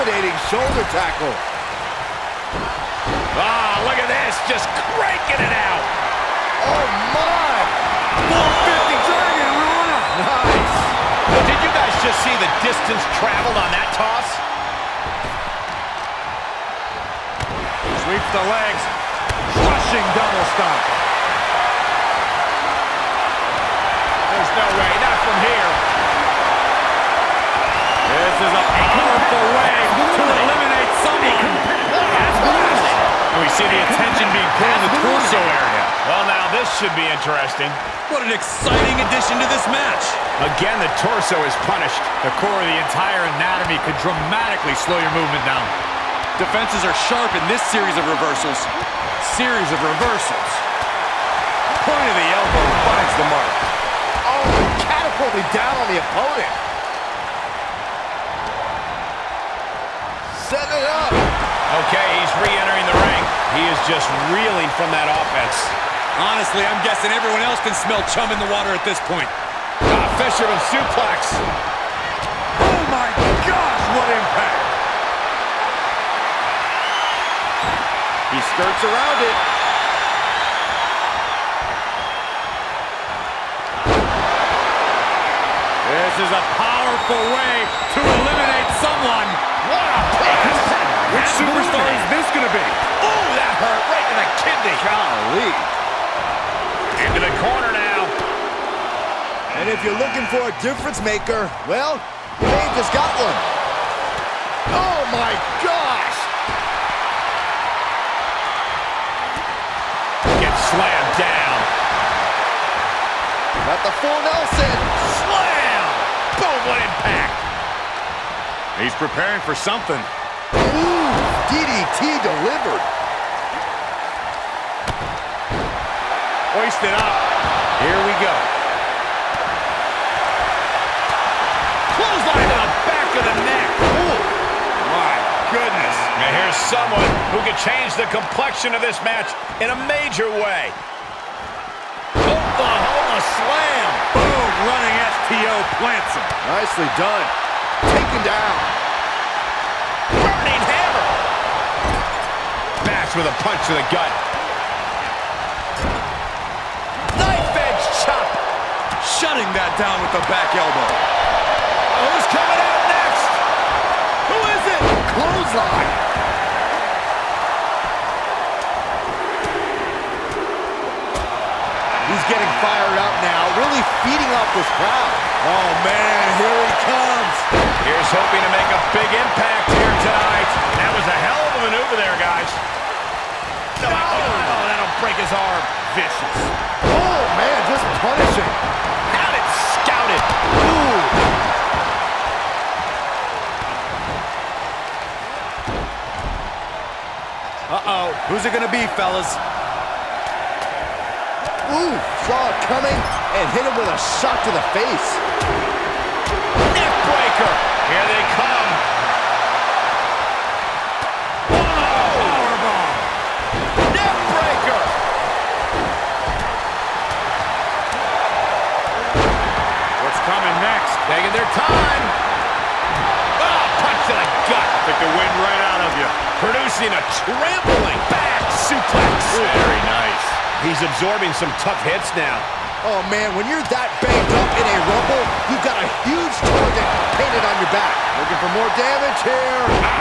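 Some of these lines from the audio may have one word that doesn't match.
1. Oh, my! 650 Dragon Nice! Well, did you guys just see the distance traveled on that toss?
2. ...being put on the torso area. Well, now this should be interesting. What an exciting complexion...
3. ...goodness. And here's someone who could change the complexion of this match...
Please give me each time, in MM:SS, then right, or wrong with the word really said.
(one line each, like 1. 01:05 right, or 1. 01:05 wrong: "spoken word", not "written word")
1. 00:06 wrong: "450", not "650"
2. 00:34 wrong: "addition", not "complexion"
3. 02:15 right.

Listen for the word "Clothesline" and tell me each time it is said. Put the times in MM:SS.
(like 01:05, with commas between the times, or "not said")
02:11, 02:45.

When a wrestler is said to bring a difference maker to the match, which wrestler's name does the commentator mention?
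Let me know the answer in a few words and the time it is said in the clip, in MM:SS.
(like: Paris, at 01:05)
Paige, at 01:42.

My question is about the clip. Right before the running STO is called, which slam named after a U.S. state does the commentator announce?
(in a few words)
Oklahoma slam.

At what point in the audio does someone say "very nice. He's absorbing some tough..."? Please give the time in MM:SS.
03:49.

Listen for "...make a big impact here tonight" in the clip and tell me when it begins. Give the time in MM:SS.
02:58.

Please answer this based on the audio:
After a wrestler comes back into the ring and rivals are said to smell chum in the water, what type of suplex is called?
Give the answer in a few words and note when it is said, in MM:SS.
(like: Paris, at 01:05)
Fisherman suplex, at 01:10.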